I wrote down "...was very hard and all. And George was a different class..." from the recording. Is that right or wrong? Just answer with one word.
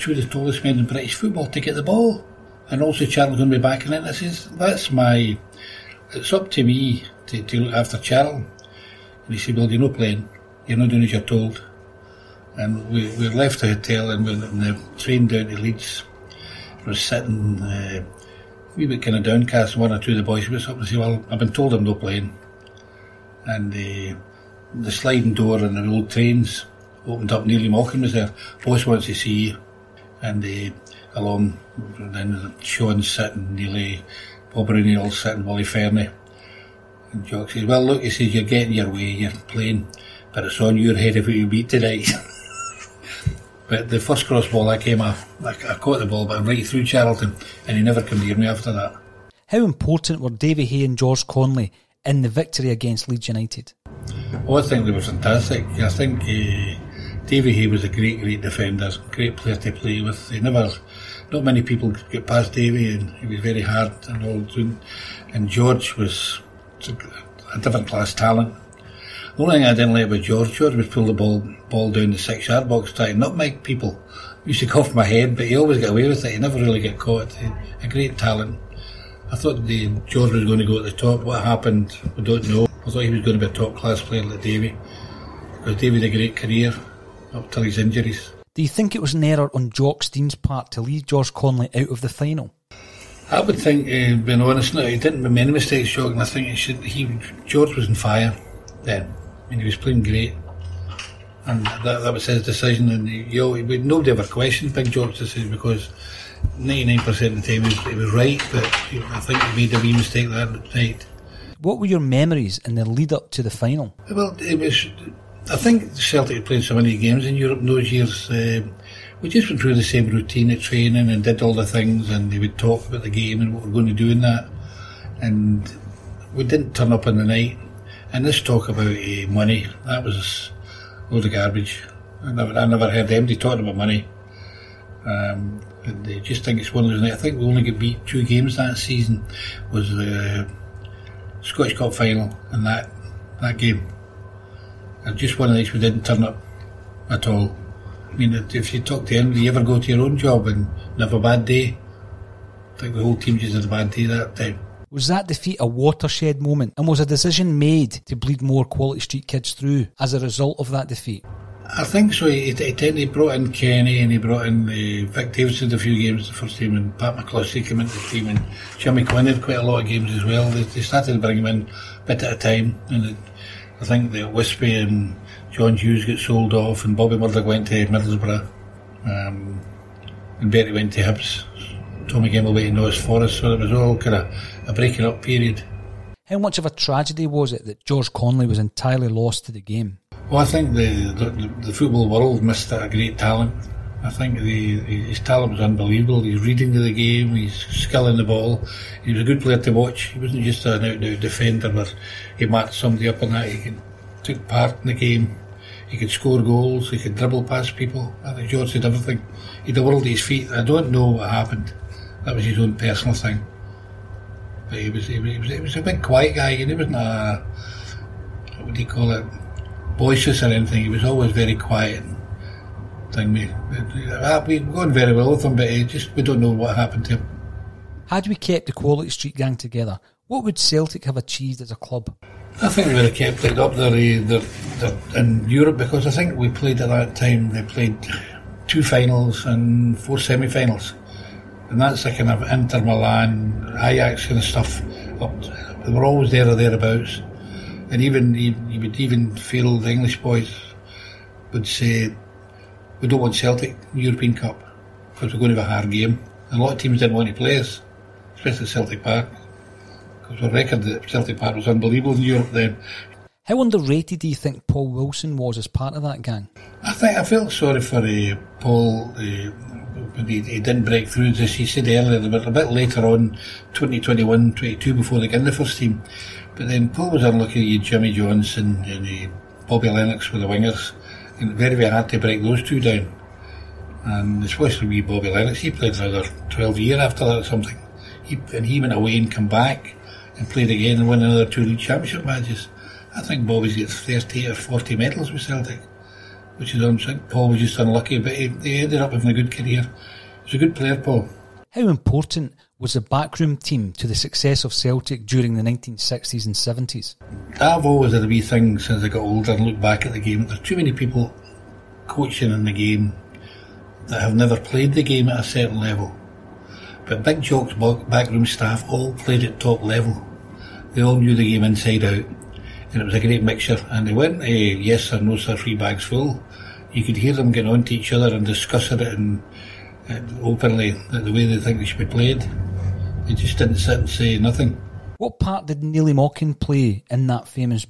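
right.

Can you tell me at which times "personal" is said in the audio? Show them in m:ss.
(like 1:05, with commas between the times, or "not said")
3:32.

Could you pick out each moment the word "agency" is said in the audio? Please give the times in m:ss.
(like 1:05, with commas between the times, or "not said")
not said.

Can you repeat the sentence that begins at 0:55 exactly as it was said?
I think uh, Davy Hay was a great, great defender, great player to play with.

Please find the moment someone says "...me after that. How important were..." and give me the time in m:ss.
0:48.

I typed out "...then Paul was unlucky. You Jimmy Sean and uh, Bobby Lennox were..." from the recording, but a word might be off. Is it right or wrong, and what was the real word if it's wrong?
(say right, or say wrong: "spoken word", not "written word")
wrong: "Johnstone", not "Sean".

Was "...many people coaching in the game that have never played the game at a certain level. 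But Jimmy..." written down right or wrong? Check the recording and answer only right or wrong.
wrong.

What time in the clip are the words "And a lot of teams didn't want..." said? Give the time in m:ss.
4:16.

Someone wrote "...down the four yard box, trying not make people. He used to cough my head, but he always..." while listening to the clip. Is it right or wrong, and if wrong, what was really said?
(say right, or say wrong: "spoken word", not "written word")
wrong: "six", not "four".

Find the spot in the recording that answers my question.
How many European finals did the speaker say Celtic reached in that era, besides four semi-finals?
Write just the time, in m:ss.
3:58.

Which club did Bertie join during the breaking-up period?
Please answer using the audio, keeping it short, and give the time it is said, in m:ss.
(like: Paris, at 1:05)
Hibs, at 3:01.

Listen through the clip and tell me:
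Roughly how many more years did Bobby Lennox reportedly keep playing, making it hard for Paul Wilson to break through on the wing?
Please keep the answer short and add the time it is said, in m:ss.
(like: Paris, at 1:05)
12, at 4:46.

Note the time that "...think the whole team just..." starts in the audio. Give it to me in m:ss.
2:32.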